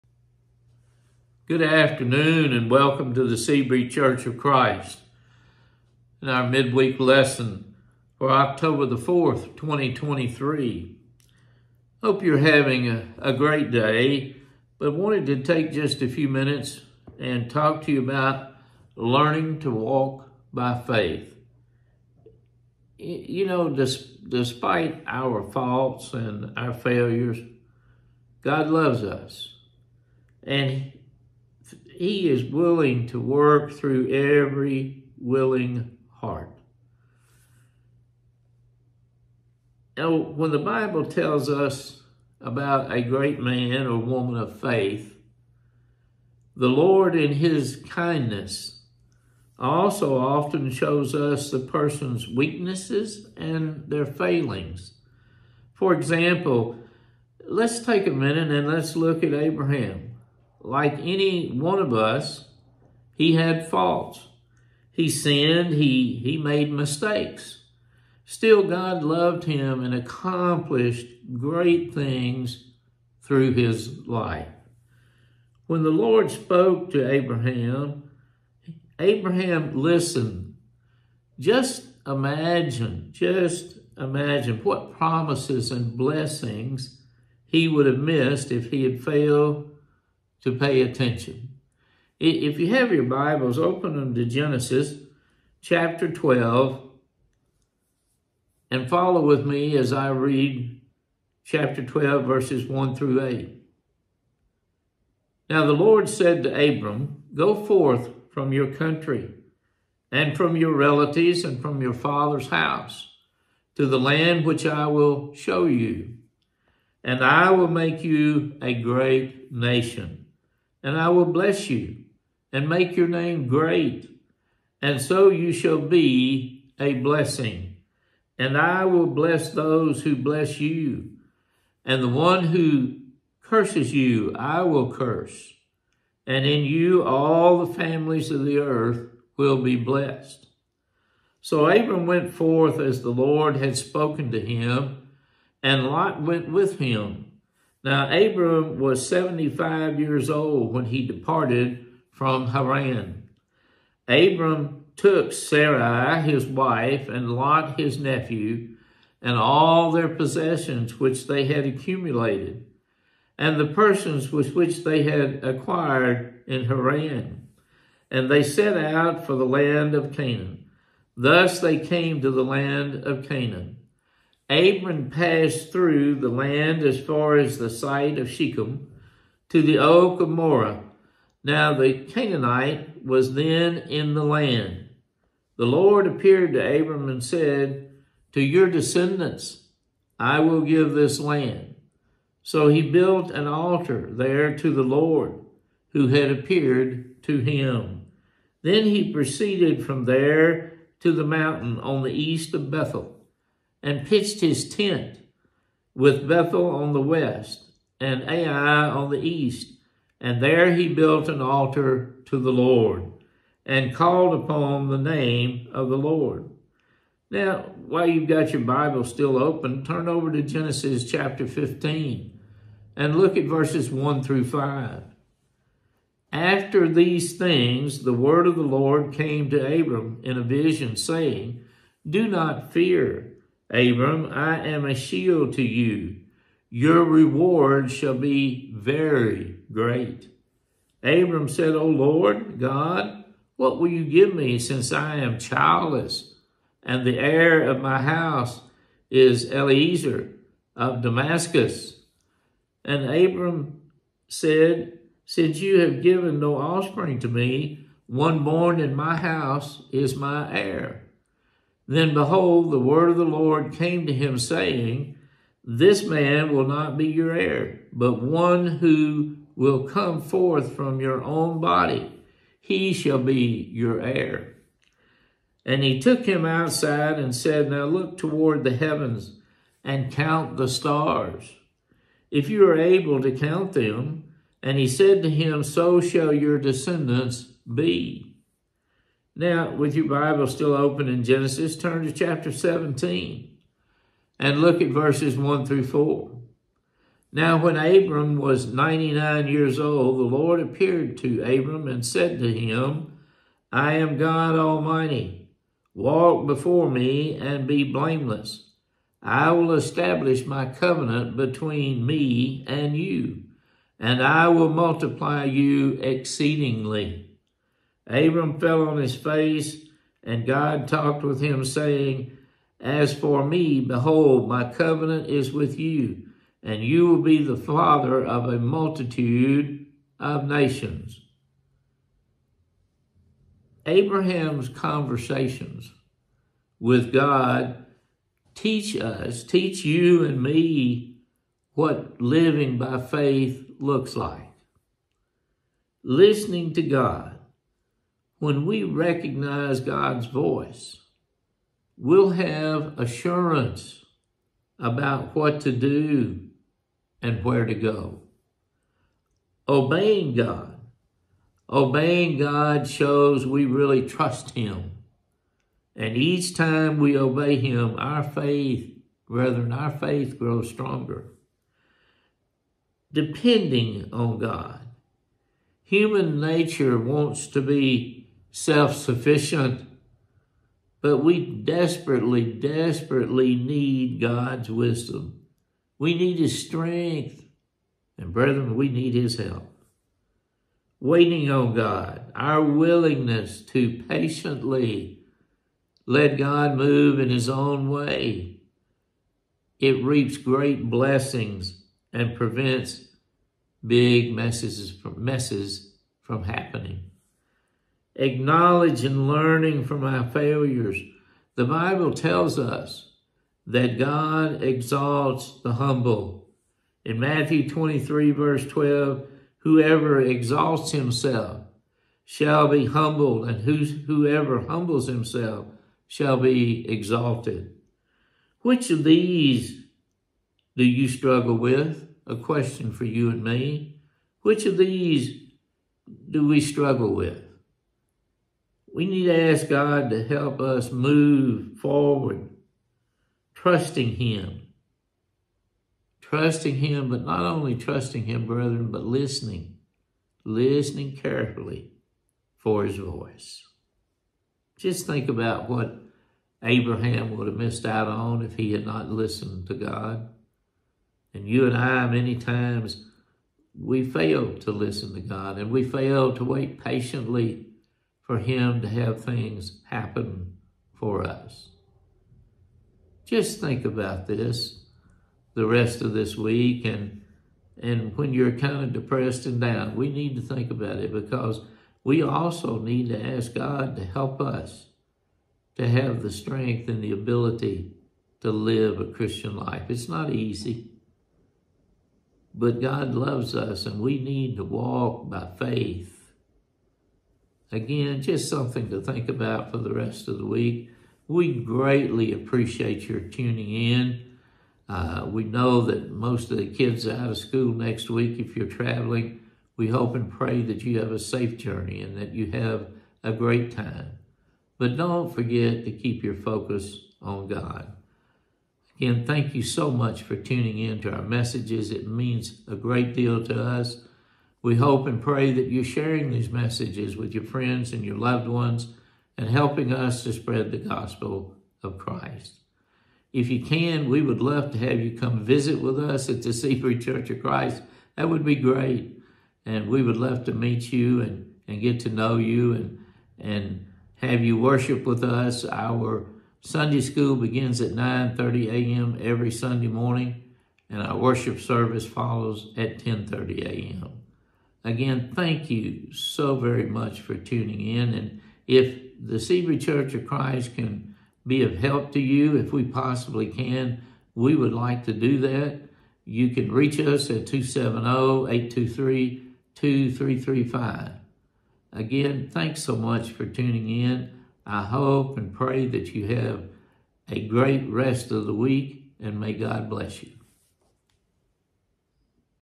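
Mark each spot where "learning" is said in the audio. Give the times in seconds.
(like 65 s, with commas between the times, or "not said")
18 s, 409 s.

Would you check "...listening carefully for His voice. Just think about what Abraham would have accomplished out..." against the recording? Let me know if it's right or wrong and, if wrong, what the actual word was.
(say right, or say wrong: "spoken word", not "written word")
wrong: "missed", not "accomplished".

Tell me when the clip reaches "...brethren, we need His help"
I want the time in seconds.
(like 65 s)
388 s.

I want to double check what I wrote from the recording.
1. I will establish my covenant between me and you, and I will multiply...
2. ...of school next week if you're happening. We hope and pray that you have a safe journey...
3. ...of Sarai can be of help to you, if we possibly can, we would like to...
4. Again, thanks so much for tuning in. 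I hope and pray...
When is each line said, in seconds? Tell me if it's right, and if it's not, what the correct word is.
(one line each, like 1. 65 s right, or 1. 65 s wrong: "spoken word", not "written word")
1. 309 s right
2. 507 s wrong: "traveling", not "happening"
3. 560 s wrong: "Christ", not "Sarai"
4. 571 s right.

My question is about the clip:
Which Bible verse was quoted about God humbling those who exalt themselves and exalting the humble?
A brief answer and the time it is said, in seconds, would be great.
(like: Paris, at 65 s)
Matthew 23:12, at 417 s.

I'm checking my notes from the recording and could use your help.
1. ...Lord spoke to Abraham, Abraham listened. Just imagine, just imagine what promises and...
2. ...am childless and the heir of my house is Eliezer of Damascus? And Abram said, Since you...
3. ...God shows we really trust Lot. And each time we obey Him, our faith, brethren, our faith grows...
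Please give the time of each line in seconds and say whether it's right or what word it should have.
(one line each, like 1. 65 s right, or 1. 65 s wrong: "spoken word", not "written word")
1. 75 s right
2. 245 s right
3. 362 s wrong: "Him", not "Lot".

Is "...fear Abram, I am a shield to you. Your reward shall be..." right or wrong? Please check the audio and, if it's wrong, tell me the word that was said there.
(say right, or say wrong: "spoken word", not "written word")
right.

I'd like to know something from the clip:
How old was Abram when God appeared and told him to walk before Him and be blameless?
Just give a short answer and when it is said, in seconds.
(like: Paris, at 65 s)
99, at 298 s.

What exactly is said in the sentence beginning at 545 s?
Our Sunday school begins at 9.30 a.m.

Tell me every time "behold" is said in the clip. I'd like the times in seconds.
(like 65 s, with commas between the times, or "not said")
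262 s, 323 s.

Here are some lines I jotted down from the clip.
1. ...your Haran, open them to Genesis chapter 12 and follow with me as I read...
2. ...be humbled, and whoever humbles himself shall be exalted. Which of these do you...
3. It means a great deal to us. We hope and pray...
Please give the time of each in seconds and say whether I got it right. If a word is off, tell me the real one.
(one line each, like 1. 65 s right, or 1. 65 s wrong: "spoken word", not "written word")
1. 92 s wrong: "Bibles", not "Haran"
2. 422 s right
3. 521 s right.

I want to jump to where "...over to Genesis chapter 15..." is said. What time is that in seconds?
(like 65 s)
220 s.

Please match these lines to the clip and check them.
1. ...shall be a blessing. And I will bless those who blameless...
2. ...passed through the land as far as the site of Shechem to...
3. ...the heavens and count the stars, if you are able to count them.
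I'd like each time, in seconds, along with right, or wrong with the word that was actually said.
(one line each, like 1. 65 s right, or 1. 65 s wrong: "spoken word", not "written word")
1. 125 s wrong: "bless", not "blameless"
2. 175 s right
3. 278 s right.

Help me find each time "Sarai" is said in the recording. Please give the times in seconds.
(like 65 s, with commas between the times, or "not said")
155 s.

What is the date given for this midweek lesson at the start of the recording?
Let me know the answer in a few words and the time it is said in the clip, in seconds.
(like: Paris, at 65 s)
October 4, 2023, at 8 s.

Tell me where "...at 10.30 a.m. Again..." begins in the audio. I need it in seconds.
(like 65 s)
552 s.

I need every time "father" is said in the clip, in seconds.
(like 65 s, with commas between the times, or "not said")
111 s, 327 s.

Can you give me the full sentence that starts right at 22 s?
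You know, despite our faults and our failures, God loves us.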